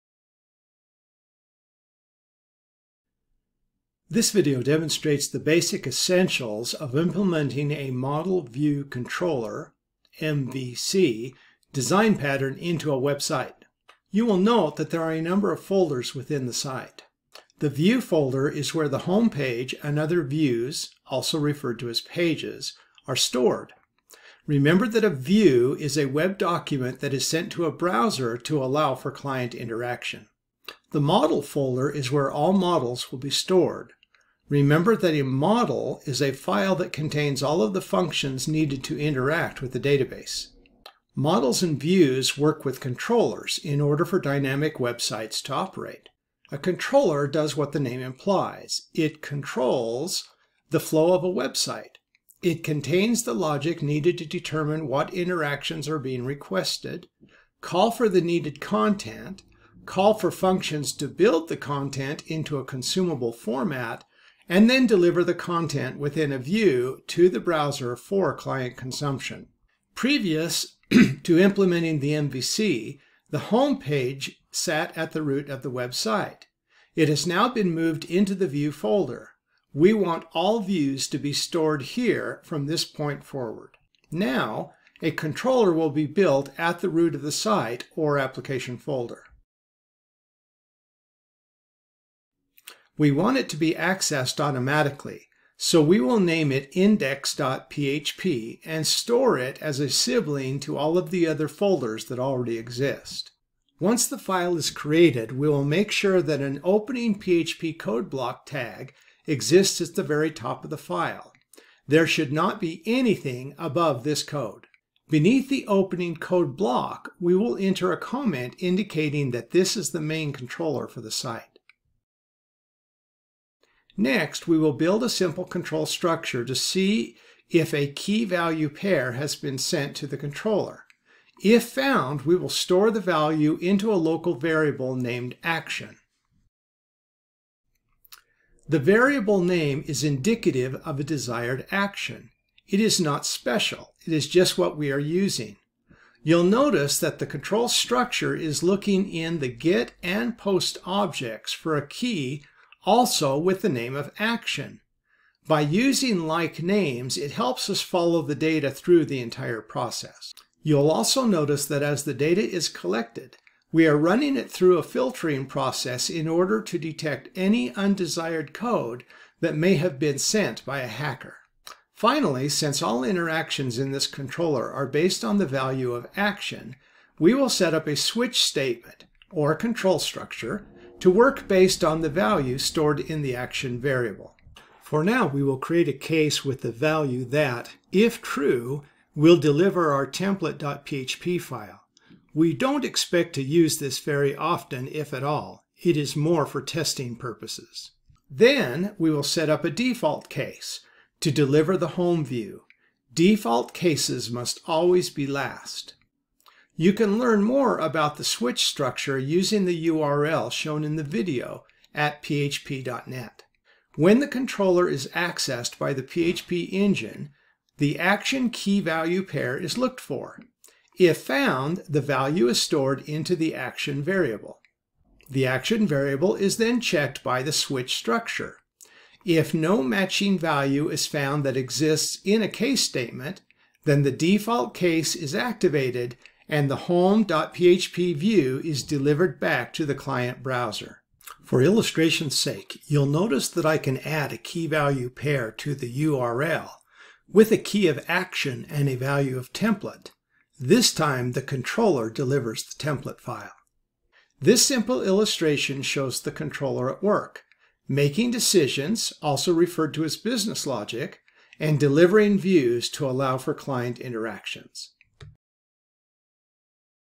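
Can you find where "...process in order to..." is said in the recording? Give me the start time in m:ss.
2:45.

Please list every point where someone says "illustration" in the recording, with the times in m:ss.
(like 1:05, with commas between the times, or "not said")
4:01, 4:15.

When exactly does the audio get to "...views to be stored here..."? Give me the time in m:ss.
1:20.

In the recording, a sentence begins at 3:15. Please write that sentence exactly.
It is more for testing purposes.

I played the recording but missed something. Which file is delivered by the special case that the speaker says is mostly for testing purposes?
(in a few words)
template.php.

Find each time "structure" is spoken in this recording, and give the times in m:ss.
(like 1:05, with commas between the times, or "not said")
2:05, 2:27, 2:59, 3:28, 3:47.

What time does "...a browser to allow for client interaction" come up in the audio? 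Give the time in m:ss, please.
0:27.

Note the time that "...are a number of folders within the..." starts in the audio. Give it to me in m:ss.
0:15.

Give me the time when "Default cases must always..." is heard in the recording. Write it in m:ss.
3:23.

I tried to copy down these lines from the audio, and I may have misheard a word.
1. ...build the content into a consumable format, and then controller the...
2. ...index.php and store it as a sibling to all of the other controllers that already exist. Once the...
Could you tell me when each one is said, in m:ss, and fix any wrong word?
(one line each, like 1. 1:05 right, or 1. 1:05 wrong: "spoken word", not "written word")
1. 1:01 wrong: "deliver", not "controller"
2. 1:36 wrong: "folders", not "controllers".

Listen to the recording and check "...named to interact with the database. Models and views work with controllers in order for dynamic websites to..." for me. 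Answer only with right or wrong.
wrong.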